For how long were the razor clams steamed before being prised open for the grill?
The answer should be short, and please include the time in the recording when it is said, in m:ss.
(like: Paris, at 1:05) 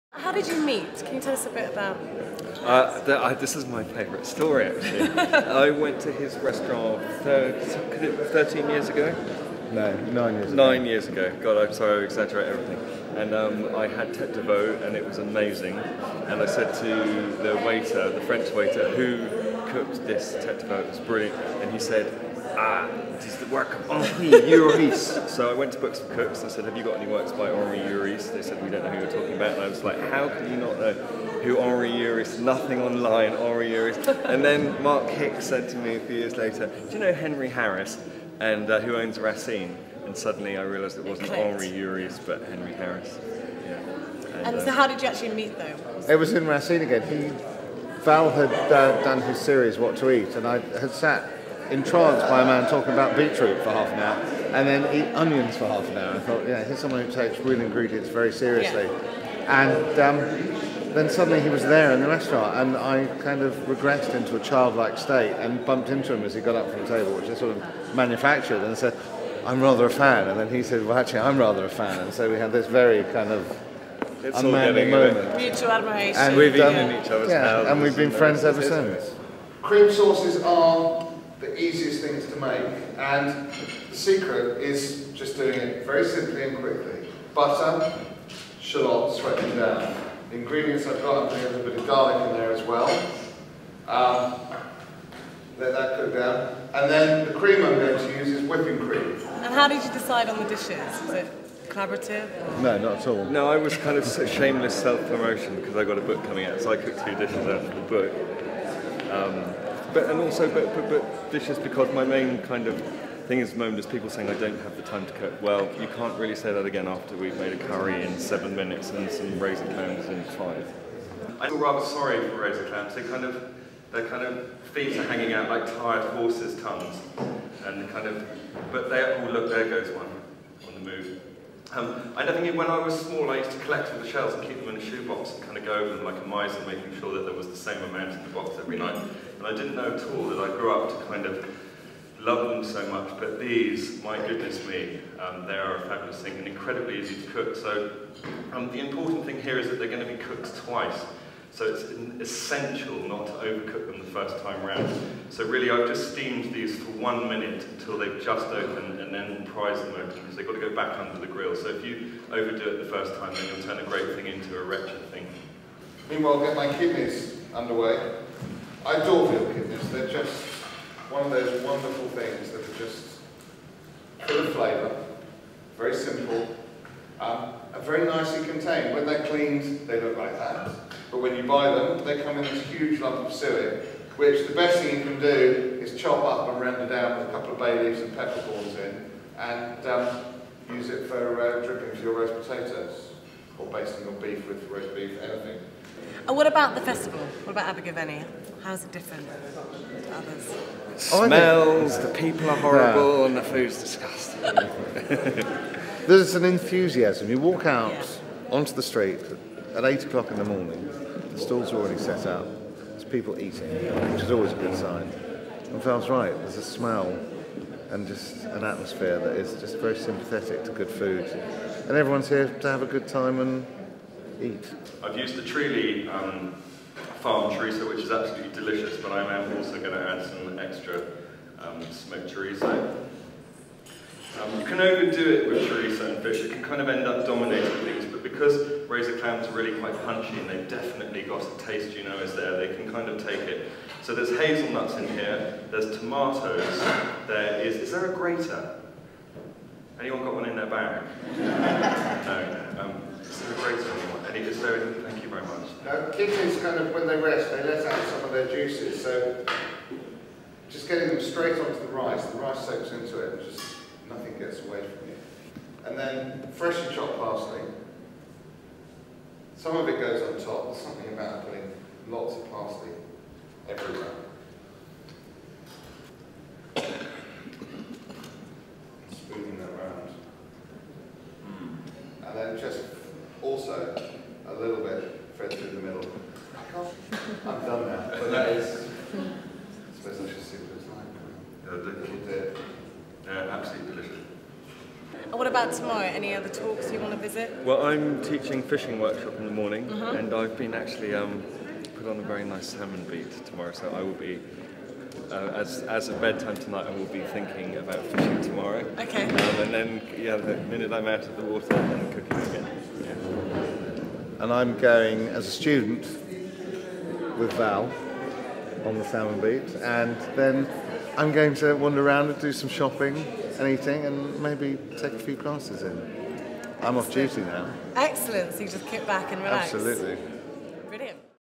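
1 minute, at 2:36.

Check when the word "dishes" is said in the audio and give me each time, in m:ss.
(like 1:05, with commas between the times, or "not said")
1:40, 1:47, 1:51.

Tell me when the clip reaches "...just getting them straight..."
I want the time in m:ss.
4:20.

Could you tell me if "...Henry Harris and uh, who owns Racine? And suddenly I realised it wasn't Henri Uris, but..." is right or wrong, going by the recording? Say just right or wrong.
right.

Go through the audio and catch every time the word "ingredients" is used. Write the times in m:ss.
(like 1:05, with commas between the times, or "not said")
0:57, 1:30.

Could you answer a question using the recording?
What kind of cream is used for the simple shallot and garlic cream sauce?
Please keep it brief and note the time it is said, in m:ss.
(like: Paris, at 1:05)
Whipping cream, at 1:38.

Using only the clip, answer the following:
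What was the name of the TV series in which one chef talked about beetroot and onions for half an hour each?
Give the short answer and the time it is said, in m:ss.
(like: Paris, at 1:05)
What to Eat, at 0:49.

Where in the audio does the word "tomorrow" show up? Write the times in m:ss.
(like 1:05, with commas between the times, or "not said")
4:55, 5:03, 5:08.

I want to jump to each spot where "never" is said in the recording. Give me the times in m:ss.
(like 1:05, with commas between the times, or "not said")
2:12.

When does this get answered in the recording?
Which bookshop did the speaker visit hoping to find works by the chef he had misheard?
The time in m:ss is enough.
0:25.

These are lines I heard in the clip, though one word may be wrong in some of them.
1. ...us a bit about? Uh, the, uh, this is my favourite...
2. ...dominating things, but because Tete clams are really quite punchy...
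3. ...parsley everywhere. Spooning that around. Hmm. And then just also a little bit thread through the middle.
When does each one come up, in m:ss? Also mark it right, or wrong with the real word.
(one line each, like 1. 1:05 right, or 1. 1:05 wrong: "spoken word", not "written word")
1. 0:01 right
2. 3:57 wrong: "Razor", not "Tete"
3. 4:32 right.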